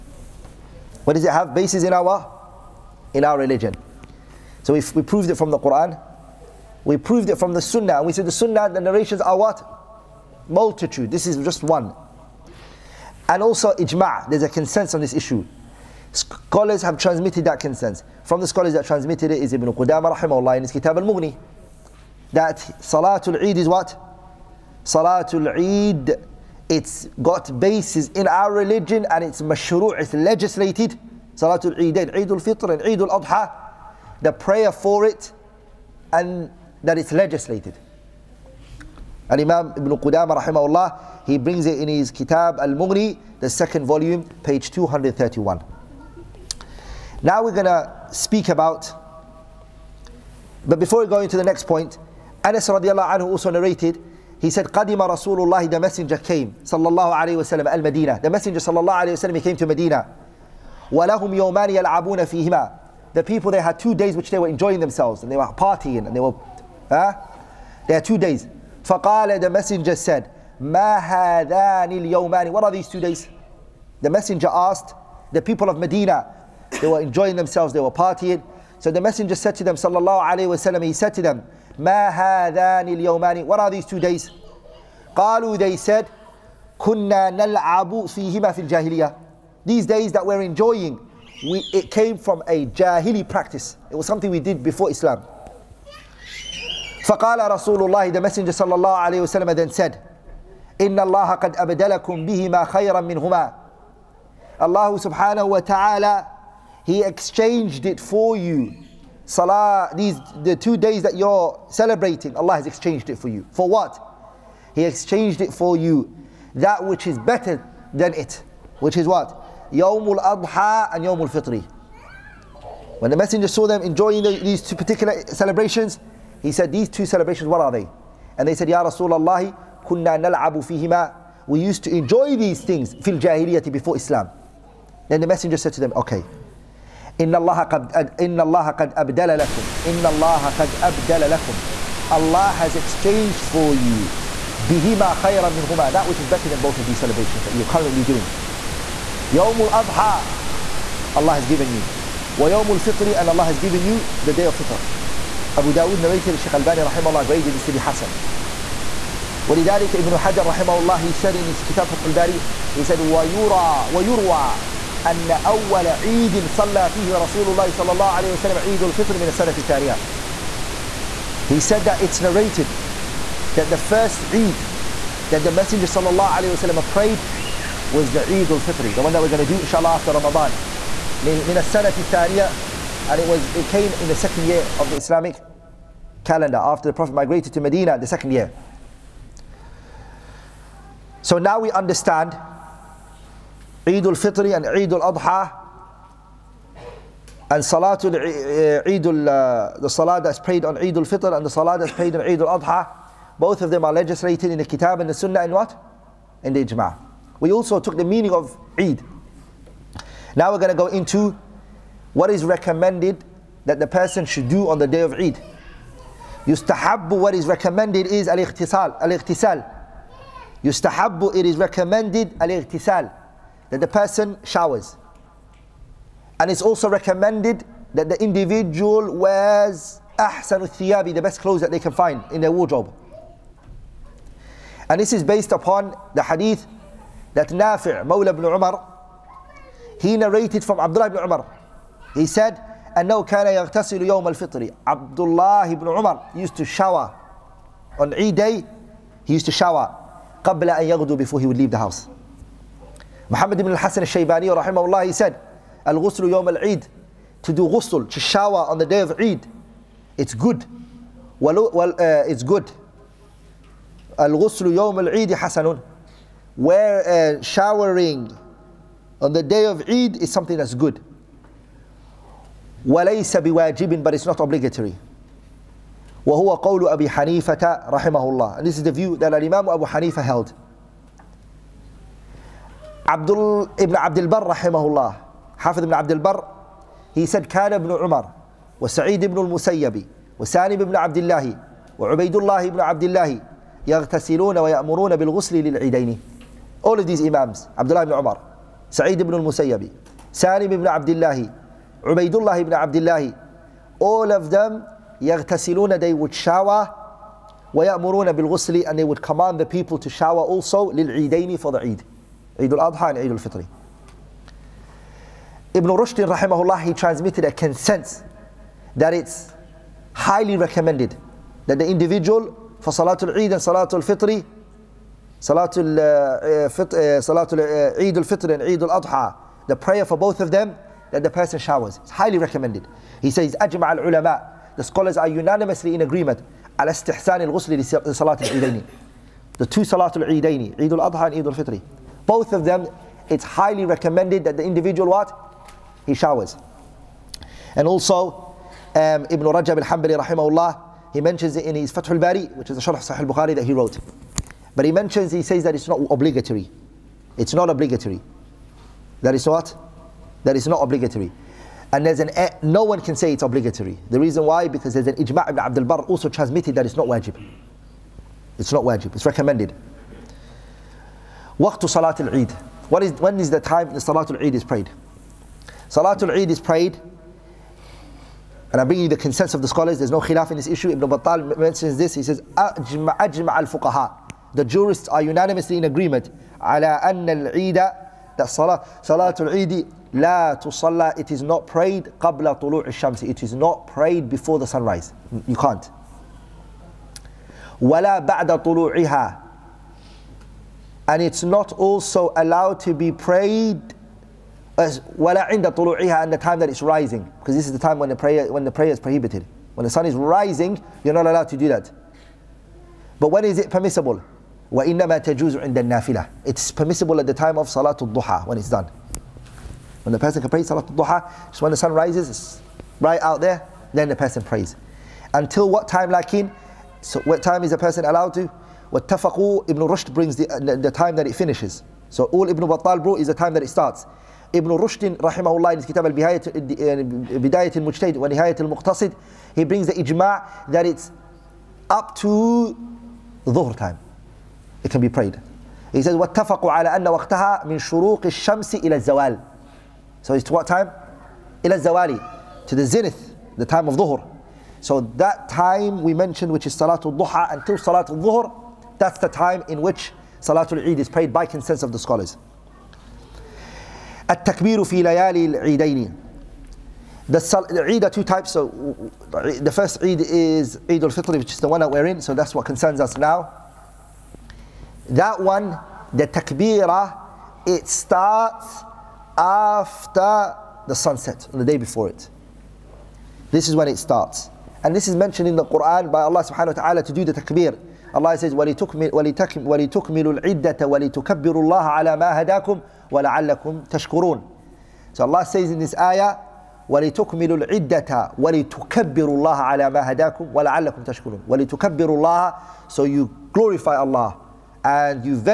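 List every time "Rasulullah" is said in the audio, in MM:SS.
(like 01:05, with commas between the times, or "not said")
00:55, 02:08.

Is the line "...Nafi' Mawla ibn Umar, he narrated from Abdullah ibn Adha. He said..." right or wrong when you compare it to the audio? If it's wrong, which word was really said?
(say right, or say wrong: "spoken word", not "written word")
wrong: "Umar", not "Adha".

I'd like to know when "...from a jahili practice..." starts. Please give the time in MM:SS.
01:32.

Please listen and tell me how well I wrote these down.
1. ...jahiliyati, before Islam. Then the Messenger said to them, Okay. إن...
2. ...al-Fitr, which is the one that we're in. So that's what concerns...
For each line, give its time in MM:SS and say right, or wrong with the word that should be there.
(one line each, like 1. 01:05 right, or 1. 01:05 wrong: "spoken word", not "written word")
1. 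02:13 right
2. 07:51 right.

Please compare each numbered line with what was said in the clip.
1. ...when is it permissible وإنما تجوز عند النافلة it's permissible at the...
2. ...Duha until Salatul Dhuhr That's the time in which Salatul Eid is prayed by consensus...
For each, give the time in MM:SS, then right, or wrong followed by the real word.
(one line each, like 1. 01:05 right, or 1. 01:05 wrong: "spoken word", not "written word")
1. 06:53 right
2. 07:37 right.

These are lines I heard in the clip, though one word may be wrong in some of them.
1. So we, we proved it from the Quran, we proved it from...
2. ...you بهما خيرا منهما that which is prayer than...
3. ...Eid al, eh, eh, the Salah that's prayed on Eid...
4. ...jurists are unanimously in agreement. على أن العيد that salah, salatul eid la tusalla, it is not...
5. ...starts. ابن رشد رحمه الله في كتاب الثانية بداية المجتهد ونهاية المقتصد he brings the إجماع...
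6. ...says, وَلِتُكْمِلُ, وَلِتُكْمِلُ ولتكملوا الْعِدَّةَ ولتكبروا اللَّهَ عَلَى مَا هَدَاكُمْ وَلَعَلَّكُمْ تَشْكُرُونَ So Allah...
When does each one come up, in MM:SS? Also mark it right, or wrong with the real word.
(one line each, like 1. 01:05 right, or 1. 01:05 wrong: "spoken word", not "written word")
1. 00:04 right
2. 02:23 wrong: "better", not "prayer"
3. 03:18 right
4. 06:24 right
5. 07:13 wrong: "البهاية", not "الثانية"
6. 08:08 right.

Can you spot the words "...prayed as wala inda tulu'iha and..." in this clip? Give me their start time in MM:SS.
06:43.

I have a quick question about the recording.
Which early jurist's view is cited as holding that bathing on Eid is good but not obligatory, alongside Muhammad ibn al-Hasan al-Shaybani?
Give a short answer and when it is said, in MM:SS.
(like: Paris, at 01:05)
Abu Hanifa, at 04:36.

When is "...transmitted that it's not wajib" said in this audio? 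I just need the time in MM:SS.
06:06.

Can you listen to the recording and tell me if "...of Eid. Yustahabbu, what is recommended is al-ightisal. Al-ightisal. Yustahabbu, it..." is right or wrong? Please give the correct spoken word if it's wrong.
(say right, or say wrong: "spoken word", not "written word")
right.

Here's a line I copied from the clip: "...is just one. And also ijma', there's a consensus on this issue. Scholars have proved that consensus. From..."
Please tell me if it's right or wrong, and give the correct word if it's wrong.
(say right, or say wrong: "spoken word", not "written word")
wrong: "transmitted", not "proved".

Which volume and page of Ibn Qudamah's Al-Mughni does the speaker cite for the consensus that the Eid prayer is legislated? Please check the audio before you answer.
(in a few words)
Volume 2, page 231.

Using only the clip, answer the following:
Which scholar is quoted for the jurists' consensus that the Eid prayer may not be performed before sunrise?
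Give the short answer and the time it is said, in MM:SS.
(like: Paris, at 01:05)
Ibn Battal, at 06:20.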